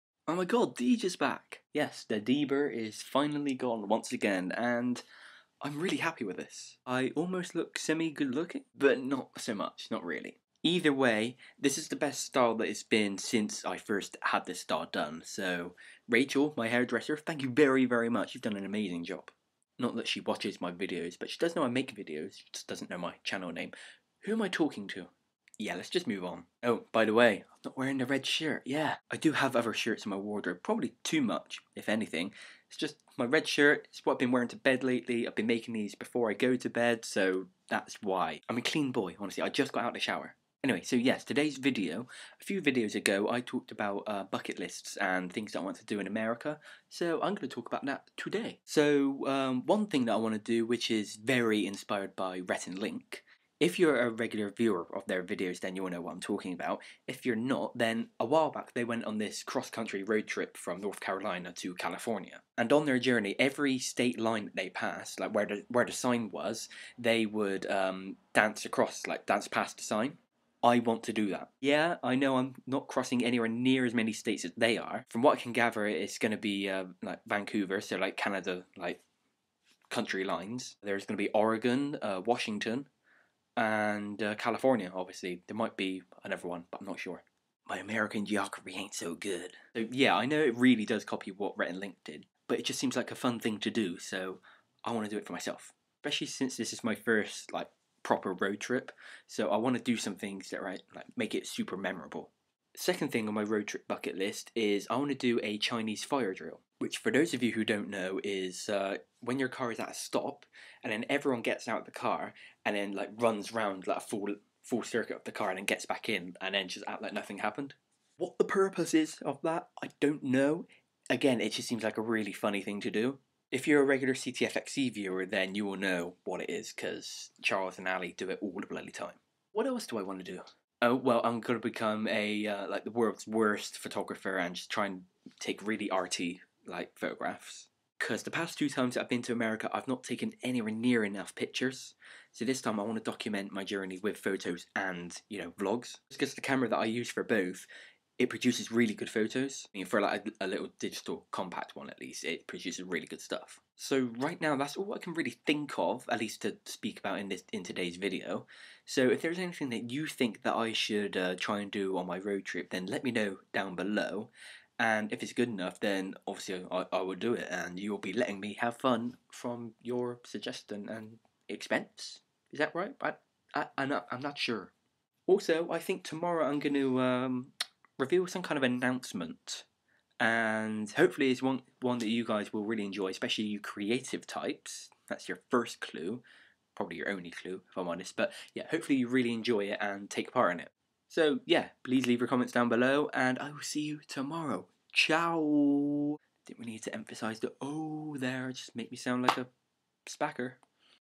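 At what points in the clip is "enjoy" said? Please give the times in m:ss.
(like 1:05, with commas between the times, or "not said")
3:02, 3:09.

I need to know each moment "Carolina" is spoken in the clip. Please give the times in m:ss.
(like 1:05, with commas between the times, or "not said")
1:00.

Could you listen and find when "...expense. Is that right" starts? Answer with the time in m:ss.
2:51.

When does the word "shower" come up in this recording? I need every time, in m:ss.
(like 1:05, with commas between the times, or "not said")
0:39.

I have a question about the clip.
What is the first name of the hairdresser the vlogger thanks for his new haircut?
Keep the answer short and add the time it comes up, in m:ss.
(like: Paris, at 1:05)
Rachel, at 0:16.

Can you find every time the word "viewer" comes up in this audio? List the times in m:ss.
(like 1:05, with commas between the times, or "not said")
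0:54, 2:04.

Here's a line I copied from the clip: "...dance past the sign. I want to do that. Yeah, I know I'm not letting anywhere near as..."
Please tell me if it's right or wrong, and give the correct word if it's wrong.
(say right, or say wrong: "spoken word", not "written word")
wrong: "crossing", not "letting".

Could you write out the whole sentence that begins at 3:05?
That's your first clue, probably your only clue, if I'm honest.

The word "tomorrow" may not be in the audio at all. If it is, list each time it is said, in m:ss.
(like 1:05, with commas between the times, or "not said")
2:56, 3:14.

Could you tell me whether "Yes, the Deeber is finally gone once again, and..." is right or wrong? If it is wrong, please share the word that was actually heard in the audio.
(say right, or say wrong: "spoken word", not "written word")
right.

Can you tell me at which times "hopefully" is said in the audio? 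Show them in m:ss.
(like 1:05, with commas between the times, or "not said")
3:00, 3:08.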